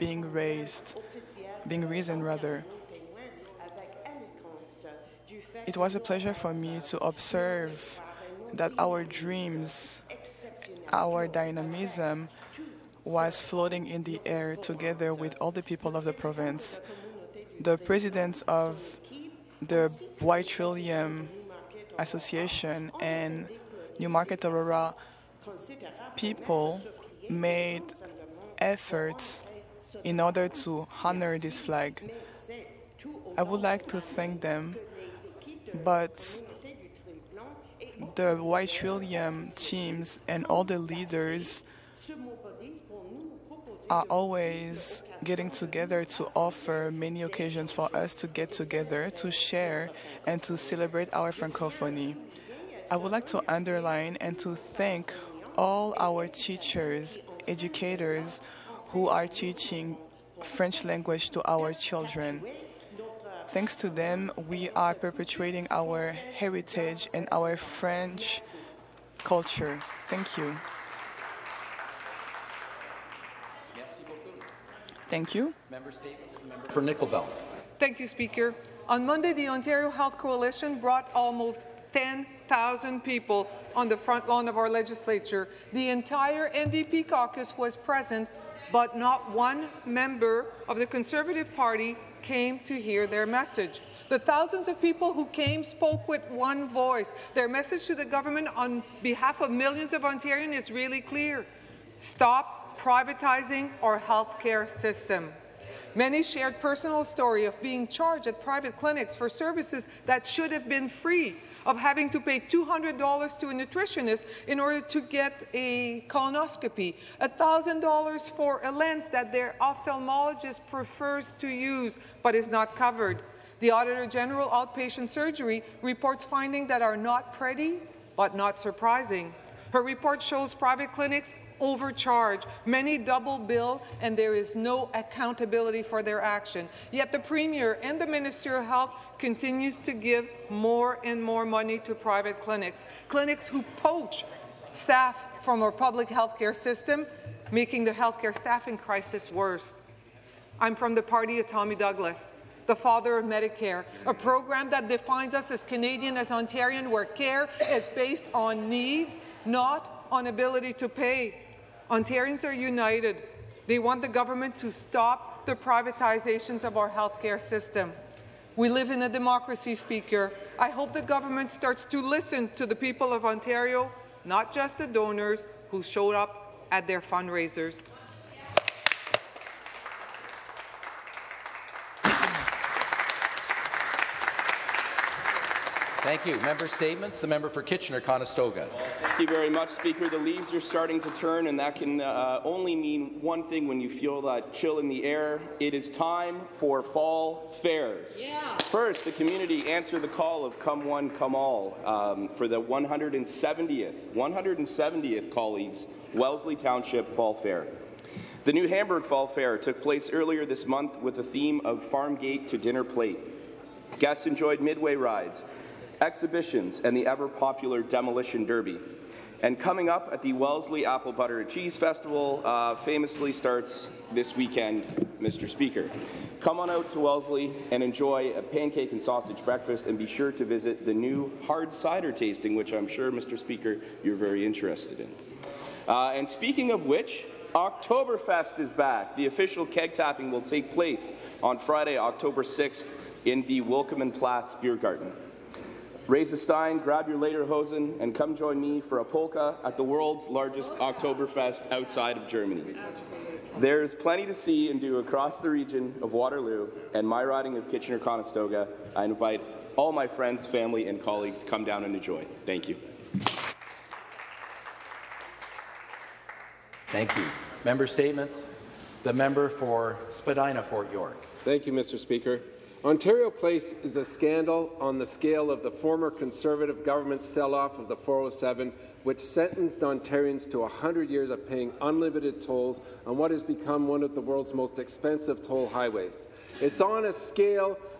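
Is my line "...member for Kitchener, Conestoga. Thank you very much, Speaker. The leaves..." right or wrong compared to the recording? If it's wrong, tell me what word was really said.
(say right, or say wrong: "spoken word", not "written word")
right.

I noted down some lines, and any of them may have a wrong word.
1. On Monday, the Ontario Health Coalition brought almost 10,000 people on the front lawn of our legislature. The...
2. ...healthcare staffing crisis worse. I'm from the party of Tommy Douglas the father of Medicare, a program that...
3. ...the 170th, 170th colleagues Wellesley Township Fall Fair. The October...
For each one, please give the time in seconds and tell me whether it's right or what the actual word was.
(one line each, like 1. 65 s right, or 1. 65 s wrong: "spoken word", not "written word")
1. 78 s right
2. 147 s right
3. 202 s wrong: "New", not "October".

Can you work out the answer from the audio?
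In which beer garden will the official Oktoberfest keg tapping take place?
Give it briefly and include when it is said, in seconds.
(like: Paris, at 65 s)
Willkommen Platz, at 243 s.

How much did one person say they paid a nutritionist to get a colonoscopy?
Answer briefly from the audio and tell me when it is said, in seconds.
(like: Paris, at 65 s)
$200, at 112 s.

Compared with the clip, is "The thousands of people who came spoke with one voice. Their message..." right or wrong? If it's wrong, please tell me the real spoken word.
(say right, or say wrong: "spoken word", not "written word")
right.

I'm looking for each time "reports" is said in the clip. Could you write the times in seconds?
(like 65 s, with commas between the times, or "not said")
125 s, 129 s.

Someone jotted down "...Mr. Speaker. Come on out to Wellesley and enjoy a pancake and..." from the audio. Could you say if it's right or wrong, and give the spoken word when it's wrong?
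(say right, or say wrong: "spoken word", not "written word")
right.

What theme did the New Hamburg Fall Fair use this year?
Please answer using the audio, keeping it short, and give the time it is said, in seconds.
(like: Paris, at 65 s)
Farm Gate to Dinner Plate, at 211 s.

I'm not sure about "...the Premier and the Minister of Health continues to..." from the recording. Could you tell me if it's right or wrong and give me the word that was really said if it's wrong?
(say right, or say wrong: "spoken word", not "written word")
right.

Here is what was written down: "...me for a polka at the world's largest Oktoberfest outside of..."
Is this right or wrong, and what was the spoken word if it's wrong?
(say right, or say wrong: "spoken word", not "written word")
right.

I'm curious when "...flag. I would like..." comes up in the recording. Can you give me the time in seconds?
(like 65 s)
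31 s.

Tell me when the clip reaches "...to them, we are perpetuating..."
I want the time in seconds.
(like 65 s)
63 s.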